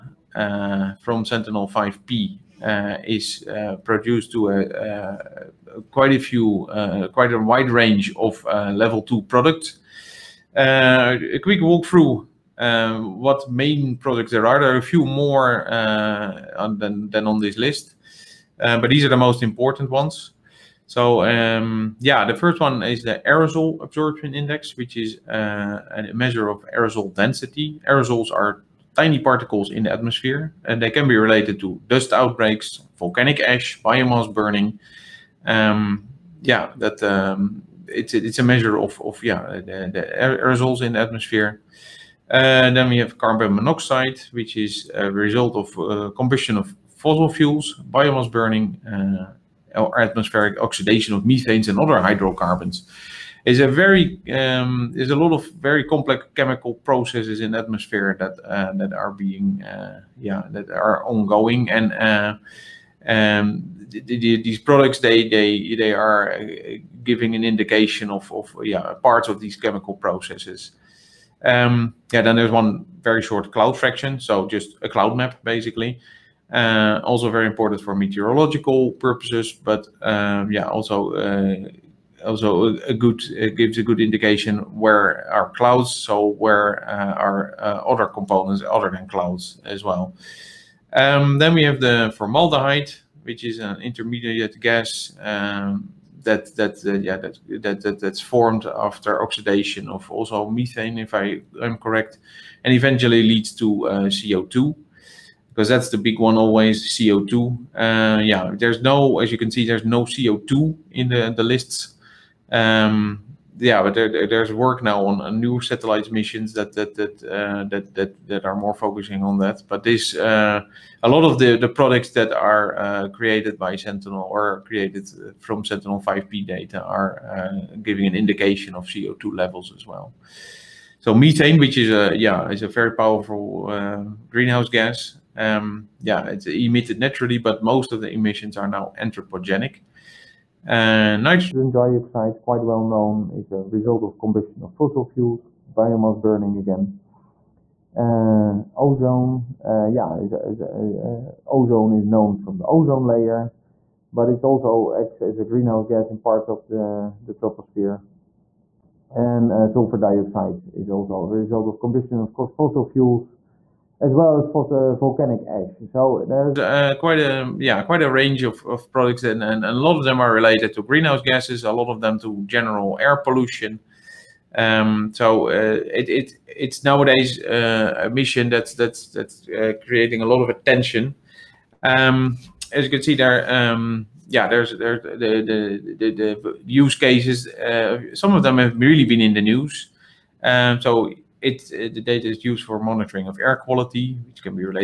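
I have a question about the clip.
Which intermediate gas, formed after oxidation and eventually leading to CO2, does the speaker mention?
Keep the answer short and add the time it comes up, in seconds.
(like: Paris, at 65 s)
Formaldehyde, at 92 s.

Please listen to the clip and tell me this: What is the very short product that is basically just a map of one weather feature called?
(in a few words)
Cloud fraction.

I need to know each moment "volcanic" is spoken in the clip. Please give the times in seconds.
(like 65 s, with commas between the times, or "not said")
32 s, 164 s.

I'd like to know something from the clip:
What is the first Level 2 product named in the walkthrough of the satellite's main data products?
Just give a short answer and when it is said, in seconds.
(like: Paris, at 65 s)
Aerosol absorption index, at 23 s.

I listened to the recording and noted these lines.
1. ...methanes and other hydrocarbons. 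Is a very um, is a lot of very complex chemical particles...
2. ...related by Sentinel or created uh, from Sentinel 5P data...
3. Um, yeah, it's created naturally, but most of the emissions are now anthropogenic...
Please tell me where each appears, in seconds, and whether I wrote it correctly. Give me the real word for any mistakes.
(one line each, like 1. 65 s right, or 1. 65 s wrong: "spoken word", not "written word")
1. 51 s wrong: "processes", not "particles"
2. 123 s wrong: "created", not "related"
3. 135 s wrong: "emitted", not "created".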